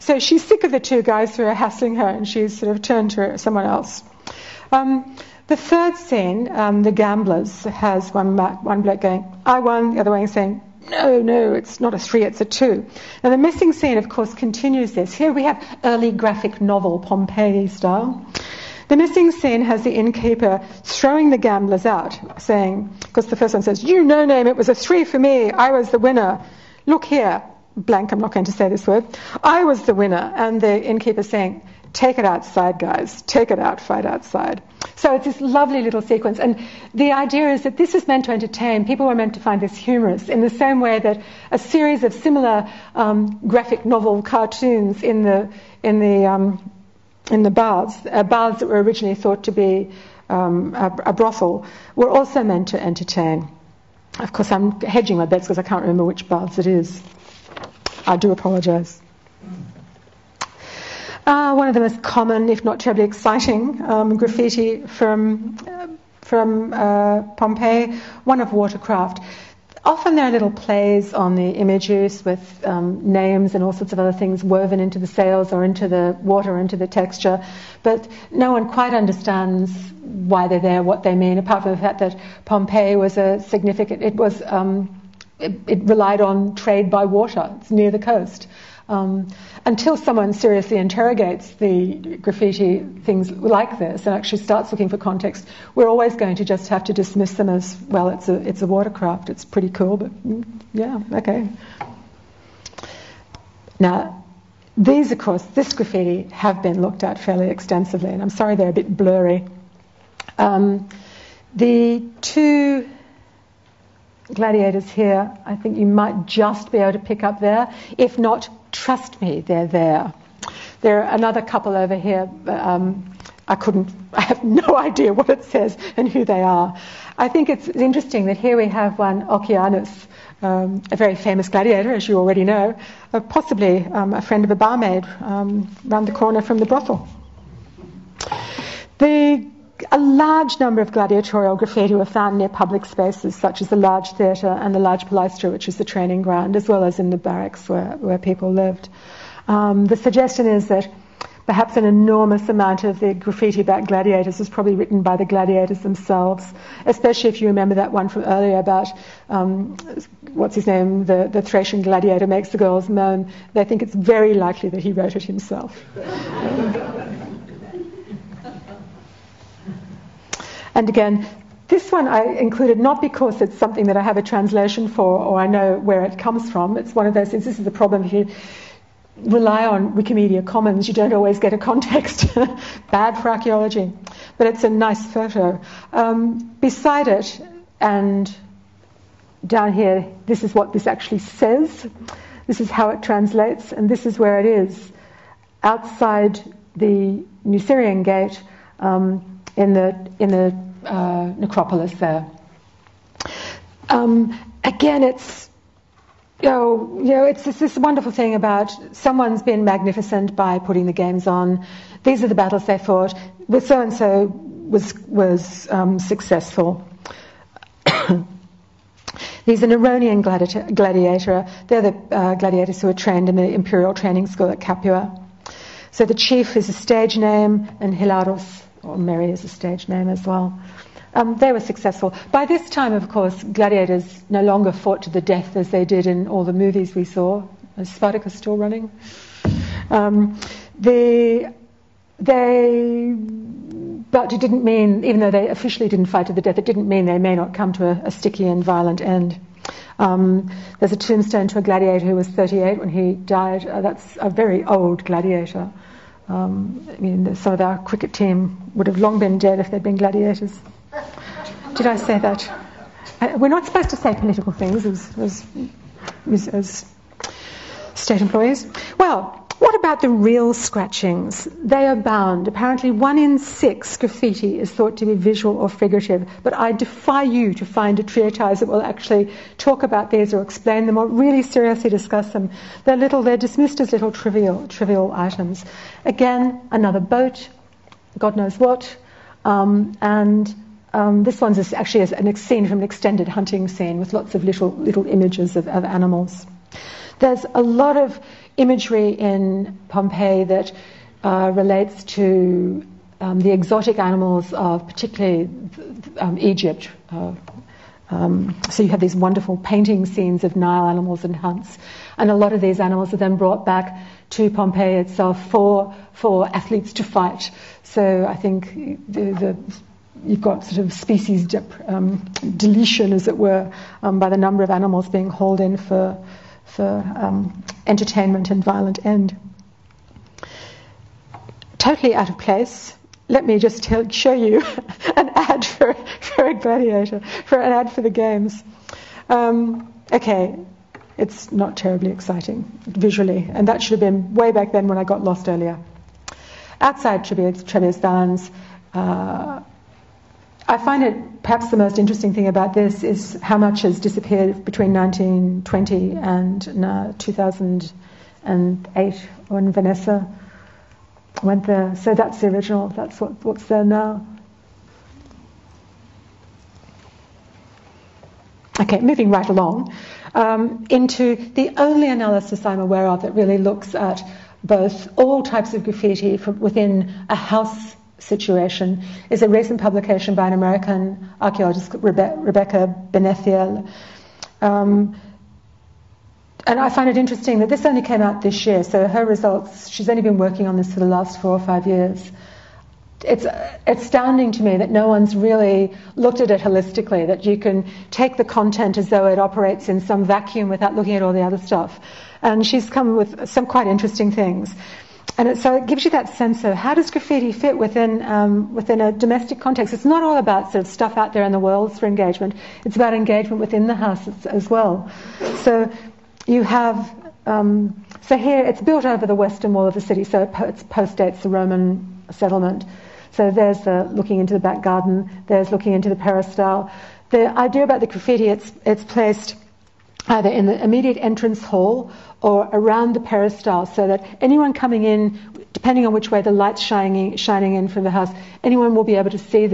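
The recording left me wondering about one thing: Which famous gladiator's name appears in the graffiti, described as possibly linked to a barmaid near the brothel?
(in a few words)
Okeanus.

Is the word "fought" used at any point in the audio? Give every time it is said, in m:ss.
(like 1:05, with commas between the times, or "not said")
3:32, 3:54.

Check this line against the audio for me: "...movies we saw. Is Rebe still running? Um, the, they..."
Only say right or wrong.
wrong.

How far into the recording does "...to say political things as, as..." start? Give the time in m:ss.
4:23.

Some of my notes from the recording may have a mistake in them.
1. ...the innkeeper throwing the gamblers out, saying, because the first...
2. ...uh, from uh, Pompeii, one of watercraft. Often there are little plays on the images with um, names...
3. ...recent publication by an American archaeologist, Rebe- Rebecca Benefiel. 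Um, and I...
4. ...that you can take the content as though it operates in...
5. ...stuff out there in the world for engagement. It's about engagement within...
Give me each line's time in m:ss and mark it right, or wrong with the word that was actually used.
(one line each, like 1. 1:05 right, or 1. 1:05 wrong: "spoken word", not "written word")
1. 0:19 right
2. 1:05 right
3. 6:19 right
4. 6:37 right
5. 6:50 right.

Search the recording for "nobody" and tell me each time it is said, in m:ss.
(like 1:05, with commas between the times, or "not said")
not said.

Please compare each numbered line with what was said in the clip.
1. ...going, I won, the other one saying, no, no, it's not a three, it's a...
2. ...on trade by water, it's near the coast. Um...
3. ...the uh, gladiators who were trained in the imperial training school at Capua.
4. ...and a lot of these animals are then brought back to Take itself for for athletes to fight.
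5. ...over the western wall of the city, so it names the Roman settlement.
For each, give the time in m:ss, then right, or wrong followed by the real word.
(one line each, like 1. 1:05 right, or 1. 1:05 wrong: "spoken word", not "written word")
1. 0:09 right
2. 1:26 right
3. 3:41 right
4. 5:12 wrong: "Pompeii", not "Take"
5. 6:59 wrong: "postdates", not "names".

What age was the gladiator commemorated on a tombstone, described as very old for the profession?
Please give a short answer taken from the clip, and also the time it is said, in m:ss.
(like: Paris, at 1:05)
38, at 4:12.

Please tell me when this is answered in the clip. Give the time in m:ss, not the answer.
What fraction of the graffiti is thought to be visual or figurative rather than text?
4:32.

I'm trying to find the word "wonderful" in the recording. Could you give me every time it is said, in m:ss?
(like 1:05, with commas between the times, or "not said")
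3:27, 5:09.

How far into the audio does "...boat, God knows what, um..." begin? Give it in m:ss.
4:46.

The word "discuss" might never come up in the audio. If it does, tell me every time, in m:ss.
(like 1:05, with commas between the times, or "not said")
4:41.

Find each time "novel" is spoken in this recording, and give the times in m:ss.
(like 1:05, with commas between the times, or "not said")
0:16, 0:43.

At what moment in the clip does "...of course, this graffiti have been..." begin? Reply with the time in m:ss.
1:45.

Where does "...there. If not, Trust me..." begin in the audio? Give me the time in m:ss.
1:57.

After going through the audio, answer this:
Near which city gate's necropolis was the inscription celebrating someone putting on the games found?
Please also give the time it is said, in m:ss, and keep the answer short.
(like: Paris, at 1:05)
Nucerian Gate, at 3:17.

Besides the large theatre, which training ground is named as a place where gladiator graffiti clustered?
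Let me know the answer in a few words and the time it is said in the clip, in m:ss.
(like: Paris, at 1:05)
The large palaestra, at 2:24.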